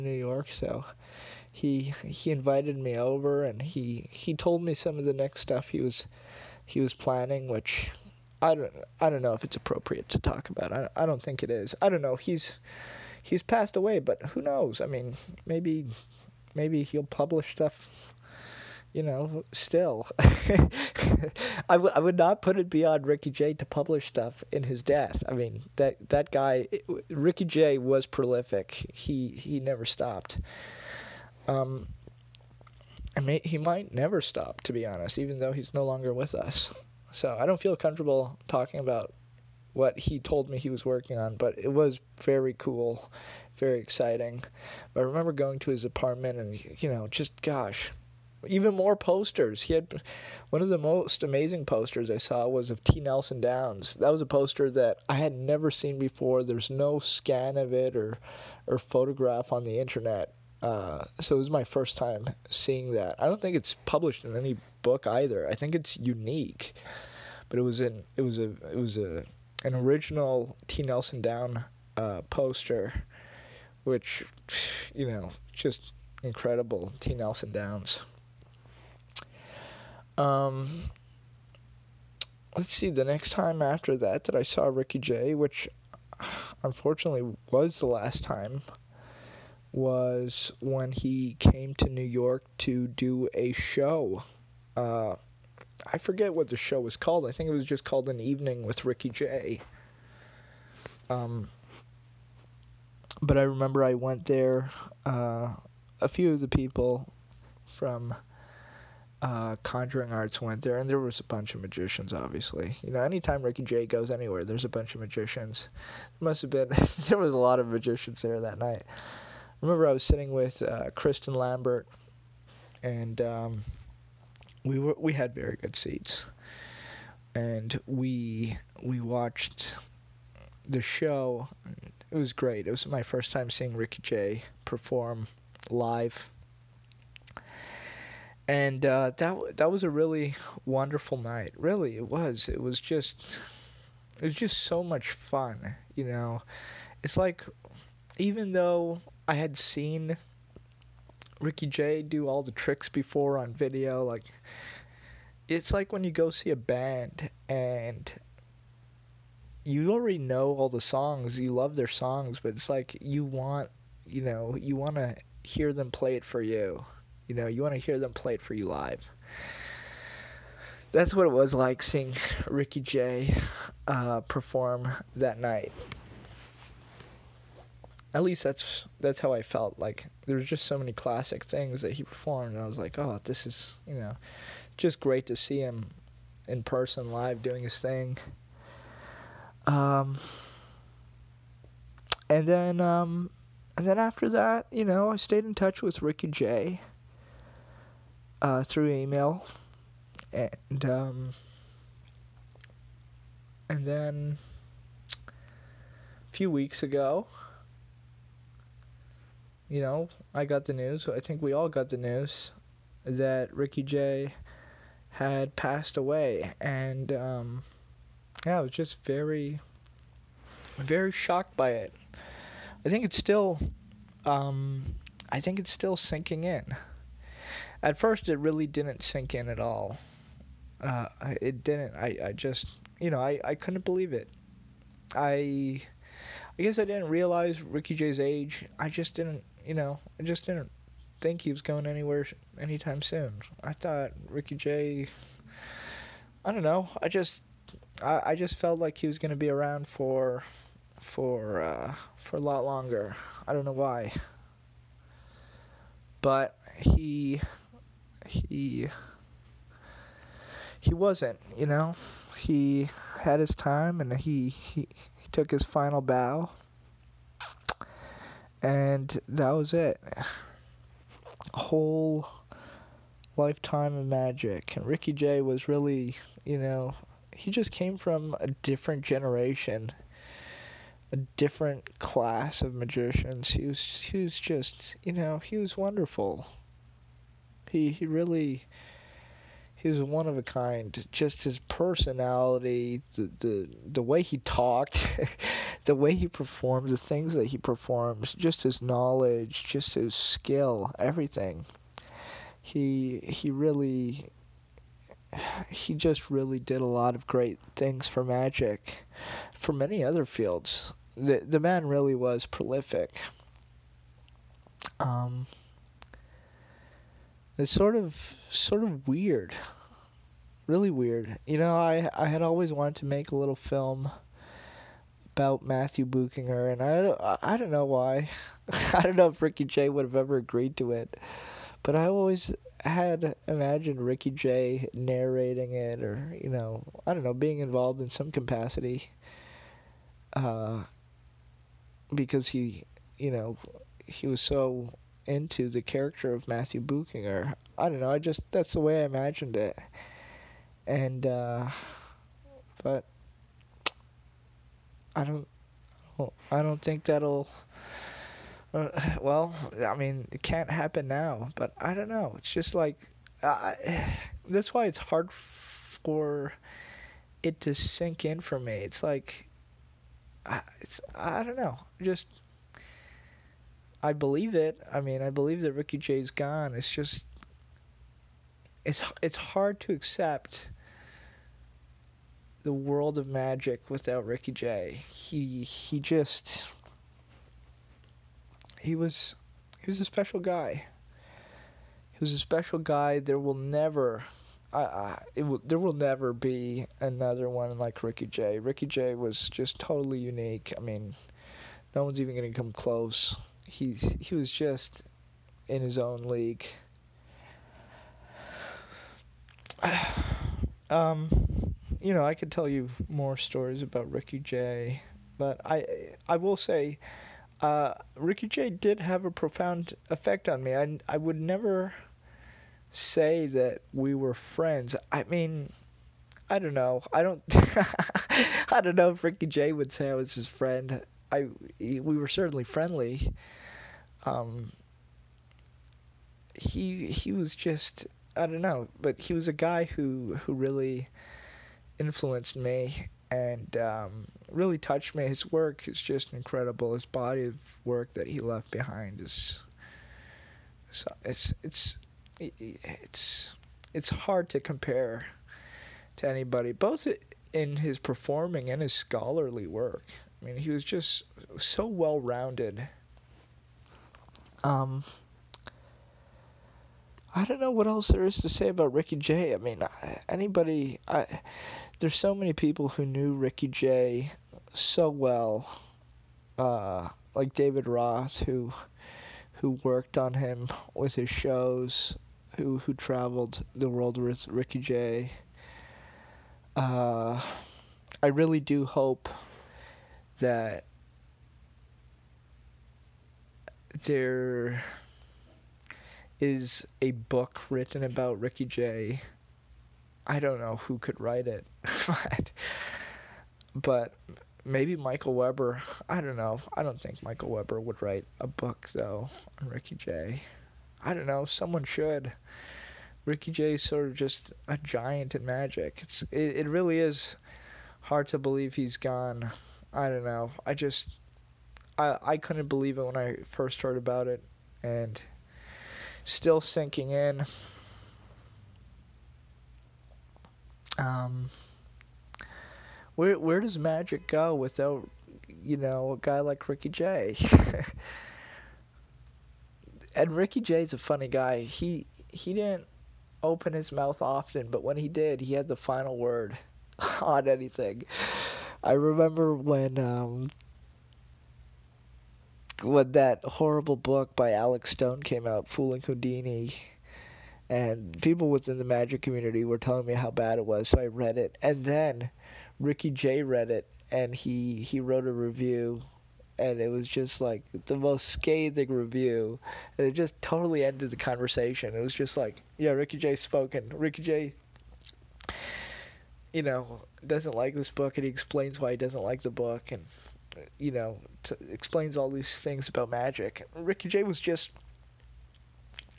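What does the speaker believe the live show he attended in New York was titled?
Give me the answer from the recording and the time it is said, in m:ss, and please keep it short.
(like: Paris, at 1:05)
An Evening with Ricky Jay, at 1:38.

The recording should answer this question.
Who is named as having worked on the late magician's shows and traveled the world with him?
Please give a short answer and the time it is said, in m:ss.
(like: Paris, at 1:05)
David Ross, at 7:57.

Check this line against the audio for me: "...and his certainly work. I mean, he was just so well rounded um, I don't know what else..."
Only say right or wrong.
wrong.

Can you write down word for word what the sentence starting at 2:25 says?
You know, it's like even though I had seen Ricky Jay do all the tricks before on video.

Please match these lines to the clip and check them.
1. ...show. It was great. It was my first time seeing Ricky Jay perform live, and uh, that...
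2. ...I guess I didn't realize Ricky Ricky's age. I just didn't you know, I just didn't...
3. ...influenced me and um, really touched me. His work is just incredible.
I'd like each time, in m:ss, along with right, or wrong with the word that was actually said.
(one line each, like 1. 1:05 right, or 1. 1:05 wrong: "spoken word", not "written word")
1. 2:10 right
2. 3:56 wrong: "Jay", not "Ricky"
3. 7:21 right.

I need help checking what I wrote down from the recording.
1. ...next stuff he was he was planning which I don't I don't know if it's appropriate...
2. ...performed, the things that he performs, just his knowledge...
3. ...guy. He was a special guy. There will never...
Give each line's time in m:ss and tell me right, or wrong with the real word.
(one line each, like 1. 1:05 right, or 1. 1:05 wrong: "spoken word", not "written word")
1. 0:05 right
2. 4:56 right
3. 6:30 right.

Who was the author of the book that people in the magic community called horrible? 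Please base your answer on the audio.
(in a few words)
Alex Stone.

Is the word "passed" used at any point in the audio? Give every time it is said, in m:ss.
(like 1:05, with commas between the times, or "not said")
0:13, 3:35.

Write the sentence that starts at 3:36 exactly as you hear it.
And, um, yeah, I was just very, very shocked by it.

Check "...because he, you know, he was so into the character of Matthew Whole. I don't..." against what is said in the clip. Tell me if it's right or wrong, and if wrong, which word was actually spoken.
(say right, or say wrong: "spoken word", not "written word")
wrong: "Buchinger", not "Whole".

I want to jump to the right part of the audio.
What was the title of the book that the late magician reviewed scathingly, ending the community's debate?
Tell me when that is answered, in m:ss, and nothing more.
9:15.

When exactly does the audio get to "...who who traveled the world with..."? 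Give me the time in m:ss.
8:02.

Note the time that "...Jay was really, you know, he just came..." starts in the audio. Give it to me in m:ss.
4:35.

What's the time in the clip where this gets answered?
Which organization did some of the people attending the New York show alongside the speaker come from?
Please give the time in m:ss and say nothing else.
1:49.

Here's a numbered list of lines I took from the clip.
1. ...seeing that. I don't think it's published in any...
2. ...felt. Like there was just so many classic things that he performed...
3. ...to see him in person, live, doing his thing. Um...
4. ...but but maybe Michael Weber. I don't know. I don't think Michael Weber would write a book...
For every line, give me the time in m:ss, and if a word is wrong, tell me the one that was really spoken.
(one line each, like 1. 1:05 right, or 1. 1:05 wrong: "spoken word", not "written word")
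1. 1:02 right
2. 2:59 right
3. 3:05 right
4. 8:22 right.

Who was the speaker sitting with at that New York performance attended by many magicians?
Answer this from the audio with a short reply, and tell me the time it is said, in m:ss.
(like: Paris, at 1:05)
Kristen Lambert, at 2:00.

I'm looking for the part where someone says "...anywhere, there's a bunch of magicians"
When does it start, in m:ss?
1:54.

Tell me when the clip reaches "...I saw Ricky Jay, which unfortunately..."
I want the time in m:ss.
1:24.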